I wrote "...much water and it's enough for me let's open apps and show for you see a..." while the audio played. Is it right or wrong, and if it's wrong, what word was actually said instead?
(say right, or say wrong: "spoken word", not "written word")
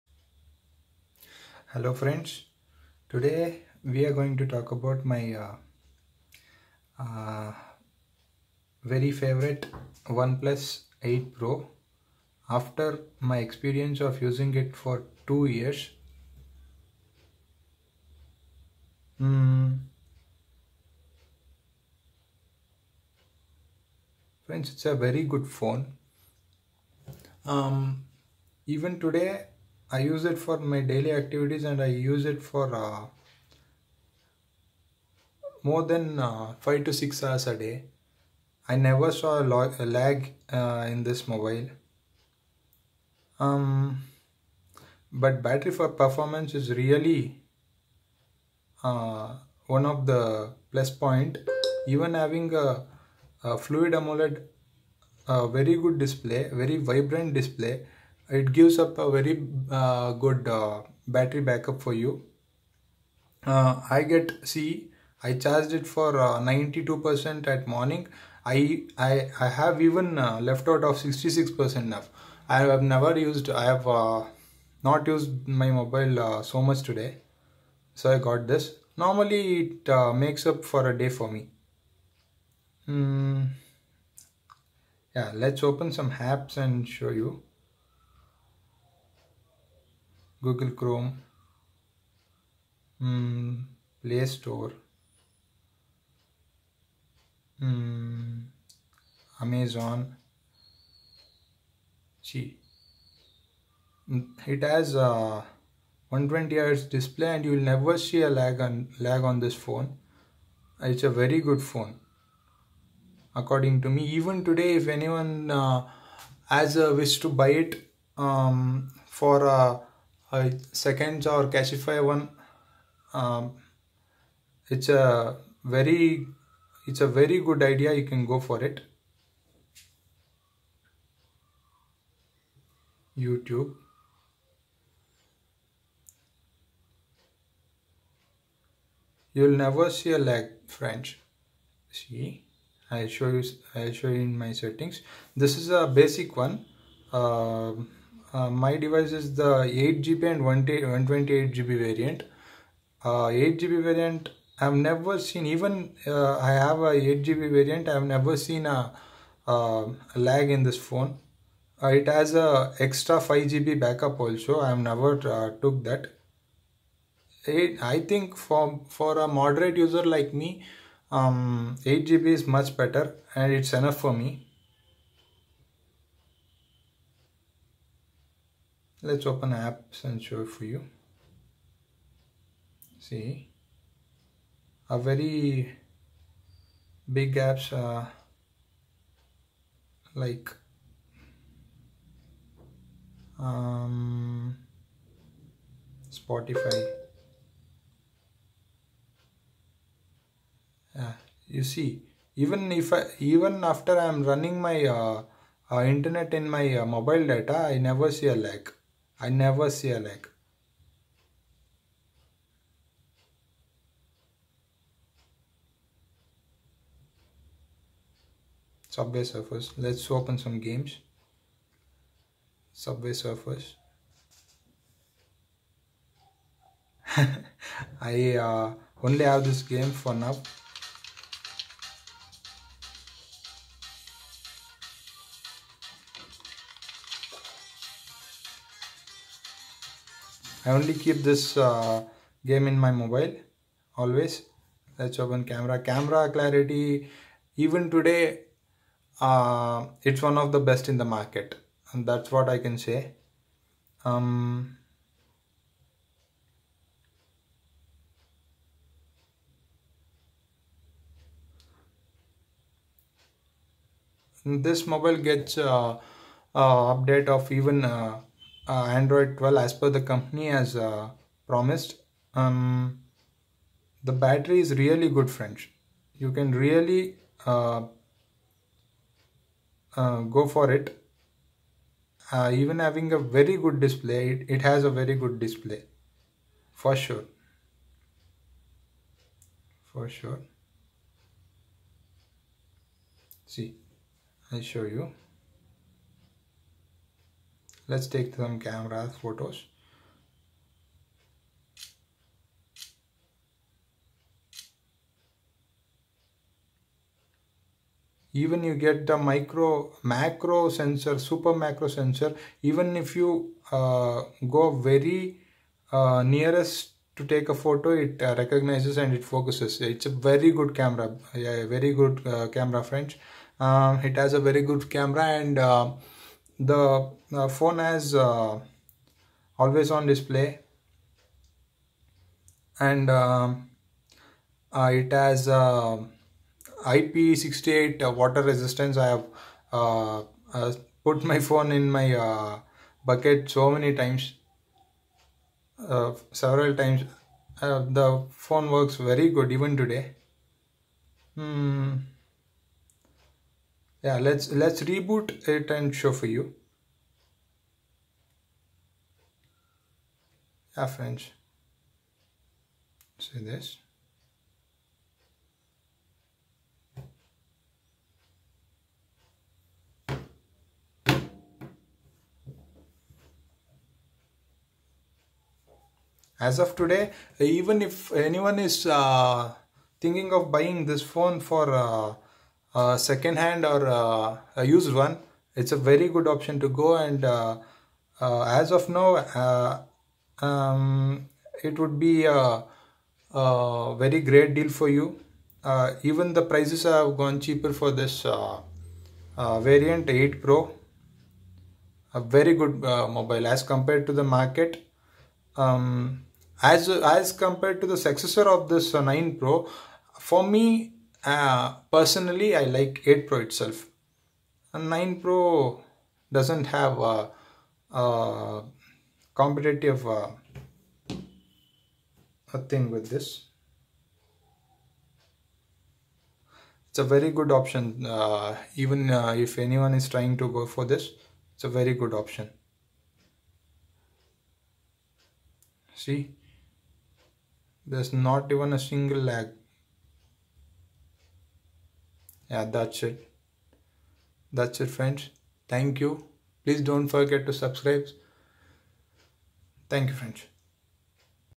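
wrong: "better", not "water".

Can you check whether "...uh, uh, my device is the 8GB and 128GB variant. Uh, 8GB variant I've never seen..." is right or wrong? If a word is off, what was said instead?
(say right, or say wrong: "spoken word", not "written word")
right.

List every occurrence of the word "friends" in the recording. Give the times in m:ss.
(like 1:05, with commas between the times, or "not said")
0:01, 0:24, 4:35, 5:22, 6:00, 7:24, 7:30.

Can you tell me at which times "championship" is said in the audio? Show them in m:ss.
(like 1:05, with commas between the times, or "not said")
not said.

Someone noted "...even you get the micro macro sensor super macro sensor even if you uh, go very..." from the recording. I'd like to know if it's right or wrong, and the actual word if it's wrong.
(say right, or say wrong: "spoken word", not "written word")
right.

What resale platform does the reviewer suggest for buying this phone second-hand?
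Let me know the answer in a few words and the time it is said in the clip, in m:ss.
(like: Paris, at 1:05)
Cashify, at 2:01.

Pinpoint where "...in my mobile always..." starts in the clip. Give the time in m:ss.
4:02.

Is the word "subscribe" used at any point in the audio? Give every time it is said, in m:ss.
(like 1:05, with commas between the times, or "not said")
7:27.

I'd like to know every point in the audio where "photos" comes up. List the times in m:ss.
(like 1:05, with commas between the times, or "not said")
4:59, 5:17.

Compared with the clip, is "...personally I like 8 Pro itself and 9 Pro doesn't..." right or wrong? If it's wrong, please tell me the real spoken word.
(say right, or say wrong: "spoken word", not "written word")
right.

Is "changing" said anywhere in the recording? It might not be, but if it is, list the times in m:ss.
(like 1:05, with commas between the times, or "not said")
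not said.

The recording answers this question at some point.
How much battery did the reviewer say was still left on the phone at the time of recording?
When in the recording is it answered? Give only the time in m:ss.
1:10.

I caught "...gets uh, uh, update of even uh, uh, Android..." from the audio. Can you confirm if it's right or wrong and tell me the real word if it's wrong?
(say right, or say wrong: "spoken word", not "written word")
right.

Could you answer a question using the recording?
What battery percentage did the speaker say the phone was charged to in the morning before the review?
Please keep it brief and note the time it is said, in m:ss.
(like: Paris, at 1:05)
92%, at 1:06.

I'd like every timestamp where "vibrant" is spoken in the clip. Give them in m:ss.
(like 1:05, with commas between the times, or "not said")
0:56.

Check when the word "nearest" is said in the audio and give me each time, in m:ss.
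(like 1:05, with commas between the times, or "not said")
5:16.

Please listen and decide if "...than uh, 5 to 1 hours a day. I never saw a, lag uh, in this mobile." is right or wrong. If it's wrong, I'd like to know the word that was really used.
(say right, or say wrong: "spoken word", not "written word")
wrong: "6", not "1".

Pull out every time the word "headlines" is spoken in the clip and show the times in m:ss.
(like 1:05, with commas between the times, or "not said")
not said.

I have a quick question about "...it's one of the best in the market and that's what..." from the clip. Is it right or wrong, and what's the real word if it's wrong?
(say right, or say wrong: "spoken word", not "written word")
right.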